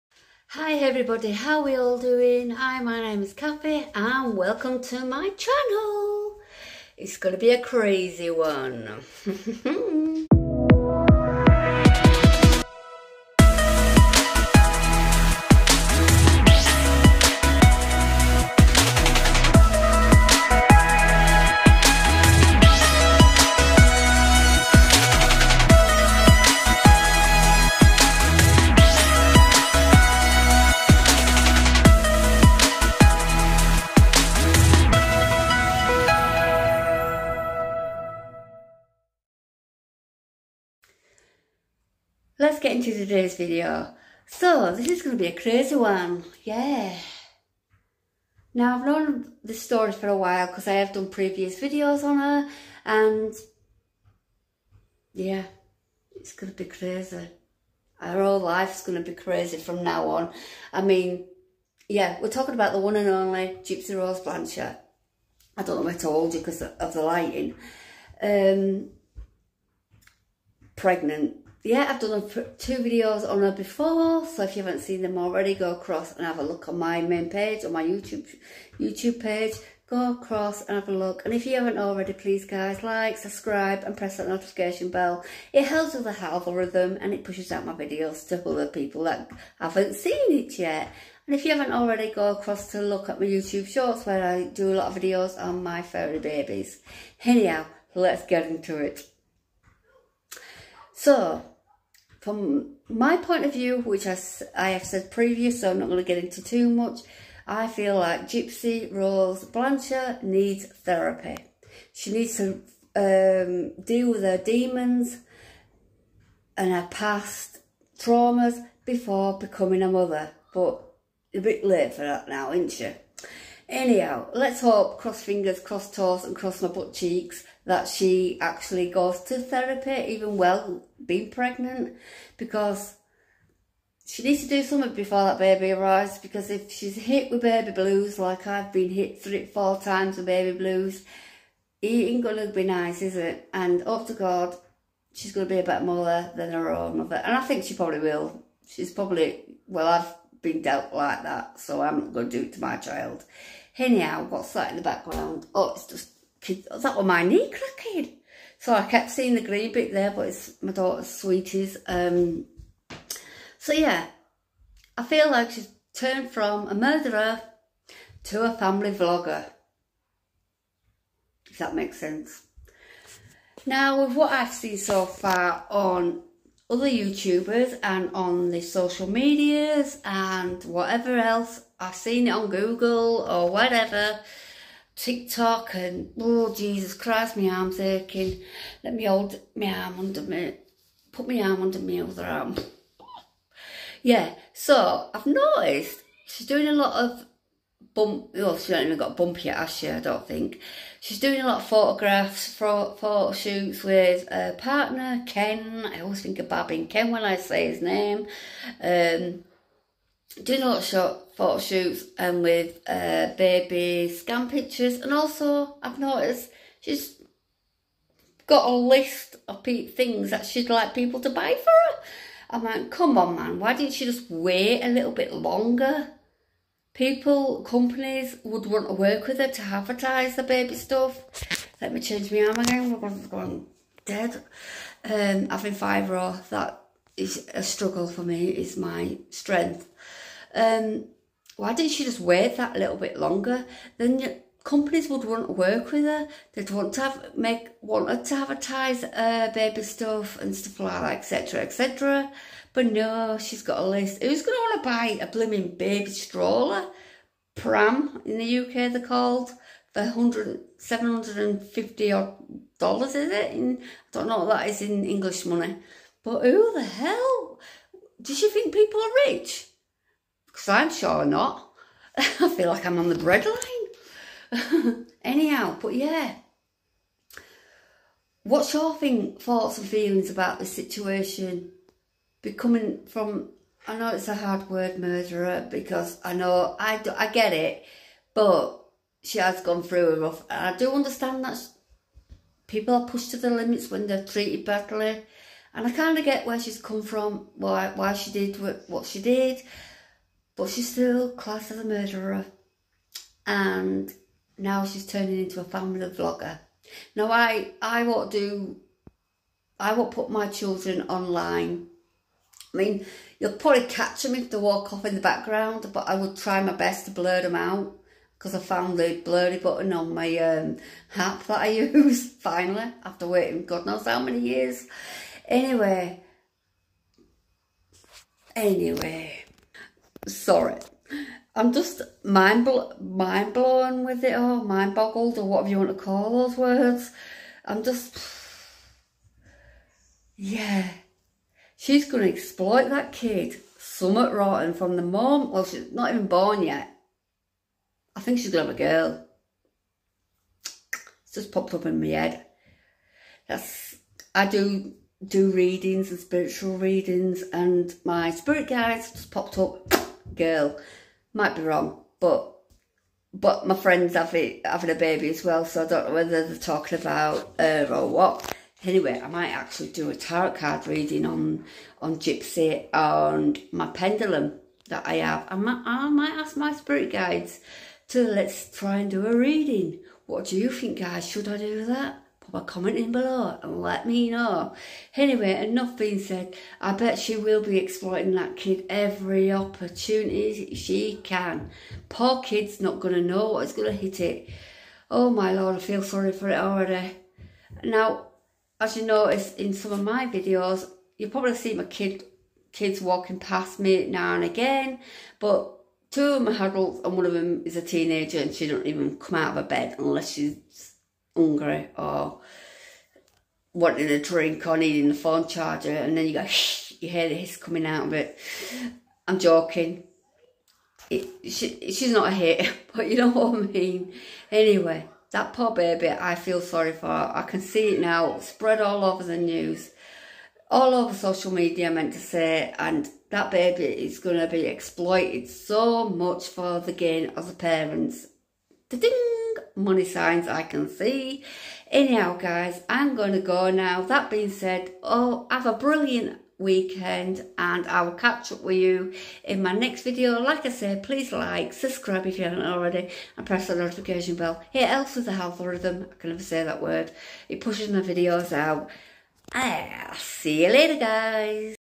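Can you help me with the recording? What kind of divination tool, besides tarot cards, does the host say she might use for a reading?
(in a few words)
pendulum.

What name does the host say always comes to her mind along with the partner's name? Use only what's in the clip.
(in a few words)
Bob.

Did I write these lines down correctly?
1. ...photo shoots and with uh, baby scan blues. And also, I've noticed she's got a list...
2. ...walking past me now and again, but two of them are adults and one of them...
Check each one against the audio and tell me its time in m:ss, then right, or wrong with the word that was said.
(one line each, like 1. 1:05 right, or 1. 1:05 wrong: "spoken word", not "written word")
1. 3:31 wrong: "pictures", not "blues"
2. 6:43 right.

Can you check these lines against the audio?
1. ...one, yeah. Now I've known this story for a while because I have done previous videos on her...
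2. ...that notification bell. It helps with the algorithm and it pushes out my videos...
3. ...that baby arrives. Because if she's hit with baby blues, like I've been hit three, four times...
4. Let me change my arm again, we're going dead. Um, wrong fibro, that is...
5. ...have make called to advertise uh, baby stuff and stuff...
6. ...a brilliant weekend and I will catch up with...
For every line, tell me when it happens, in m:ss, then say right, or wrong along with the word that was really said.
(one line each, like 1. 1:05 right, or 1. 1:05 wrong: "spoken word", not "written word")
1. 0:45 right
2. 1:24 right
3. 2:15 right
4. 3:51 wrong: "having", not "wrong"
5. 4:07 wrong: "wanted", not "called"
6. 7:25 right.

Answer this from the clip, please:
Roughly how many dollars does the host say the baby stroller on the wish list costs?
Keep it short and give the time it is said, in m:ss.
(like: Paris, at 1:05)
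750, at 4:22.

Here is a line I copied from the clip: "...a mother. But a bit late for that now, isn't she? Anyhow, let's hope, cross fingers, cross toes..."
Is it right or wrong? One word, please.
right.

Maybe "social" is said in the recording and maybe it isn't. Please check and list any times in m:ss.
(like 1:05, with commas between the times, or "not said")
2:58, 7:11.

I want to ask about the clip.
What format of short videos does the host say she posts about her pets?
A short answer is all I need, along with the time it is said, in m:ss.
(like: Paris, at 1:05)
YouTube shorts, at 1:33.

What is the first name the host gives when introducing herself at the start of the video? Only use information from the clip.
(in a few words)
Kathy.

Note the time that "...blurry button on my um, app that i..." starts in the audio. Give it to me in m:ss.
5:19.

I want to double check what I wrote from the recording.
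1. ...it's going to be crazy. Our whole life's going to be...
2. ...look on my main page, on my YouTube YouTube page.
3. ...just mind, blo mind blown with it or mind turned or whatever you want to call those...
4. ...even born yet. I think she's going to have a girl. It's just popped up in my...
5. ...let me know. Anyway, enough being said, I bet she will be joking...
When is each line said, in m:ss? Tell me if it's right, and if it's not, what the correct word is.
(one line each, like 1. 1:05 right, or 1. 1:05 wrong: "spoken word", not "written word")
1. 0:56 right
2. 1:16 right
3. 5:31 wrong: "boggled", not "turned"
4. 5:46 right
5. 6:23 wrong: "exploiting", not "joking".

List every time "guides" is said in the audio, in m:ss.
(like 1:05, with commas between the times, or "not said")
5:58, 6:17.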